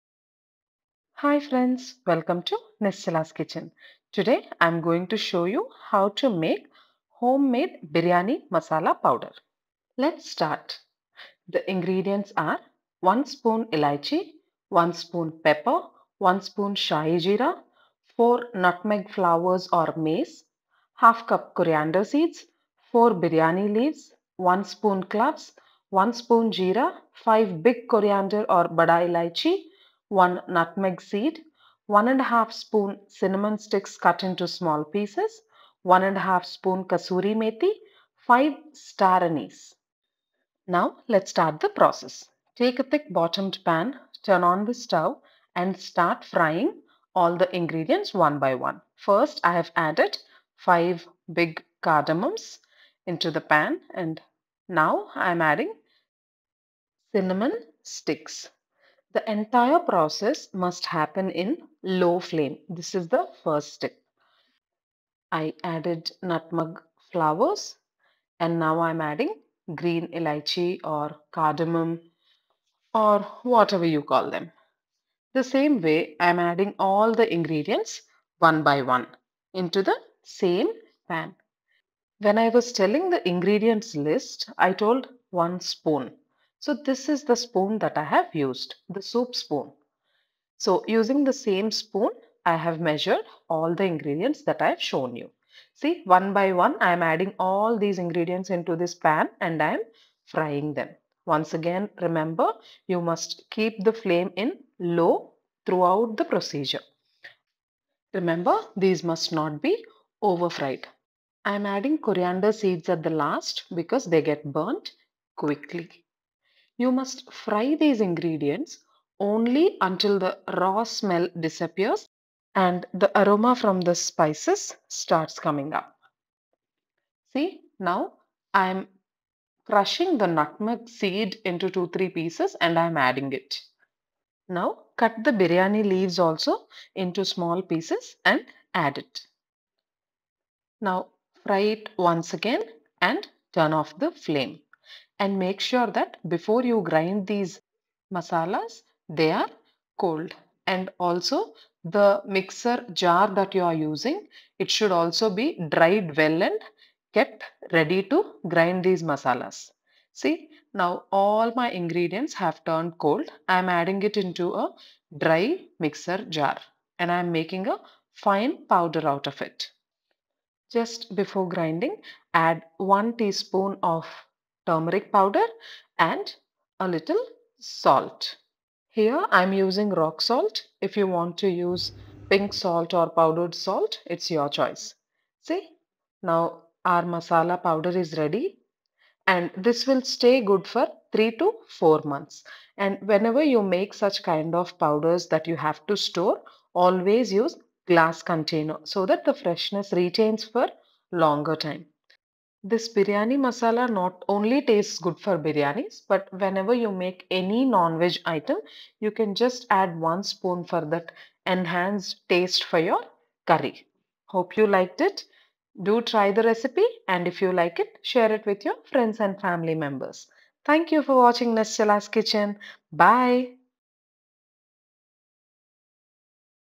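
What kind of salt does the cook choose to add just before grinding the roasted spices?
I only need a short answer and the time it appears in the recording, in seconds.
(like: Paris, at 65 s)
rock salt, at 179 s.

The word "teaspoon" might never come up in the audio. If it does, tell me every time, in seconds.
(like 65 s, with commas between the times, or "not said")
173 s.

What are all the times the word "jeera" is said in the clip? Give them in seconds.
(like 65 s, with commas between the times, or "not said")
17 s, 26 s.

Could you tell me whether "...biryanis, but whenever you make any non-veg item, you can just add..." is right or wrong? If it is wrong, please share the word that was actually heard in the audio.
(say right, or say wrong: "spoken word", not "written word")
right.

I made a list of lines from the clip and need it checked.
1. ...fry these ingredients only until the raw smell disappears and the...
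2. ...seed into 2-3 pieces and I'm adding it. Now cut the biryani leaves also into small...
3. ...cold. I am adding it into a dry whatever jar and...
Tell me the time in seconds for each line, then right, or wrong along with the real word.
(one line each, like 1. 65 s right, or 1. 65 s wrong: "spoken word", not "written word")
1. 117 s right
2. 130 s right
3. 162 s wrong: "mixer", not "whatever".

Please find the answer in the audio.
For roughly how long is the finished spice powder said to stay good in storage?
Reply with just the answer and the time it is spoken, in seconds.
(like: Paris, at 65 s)
3 to 4 months, at 191 s.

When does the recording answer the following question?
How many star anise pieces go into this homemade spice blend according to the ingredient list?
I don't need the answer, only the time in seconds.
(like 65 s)
38 s.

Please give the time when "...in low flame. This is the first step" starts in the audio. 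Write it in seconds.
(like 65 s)
61 s.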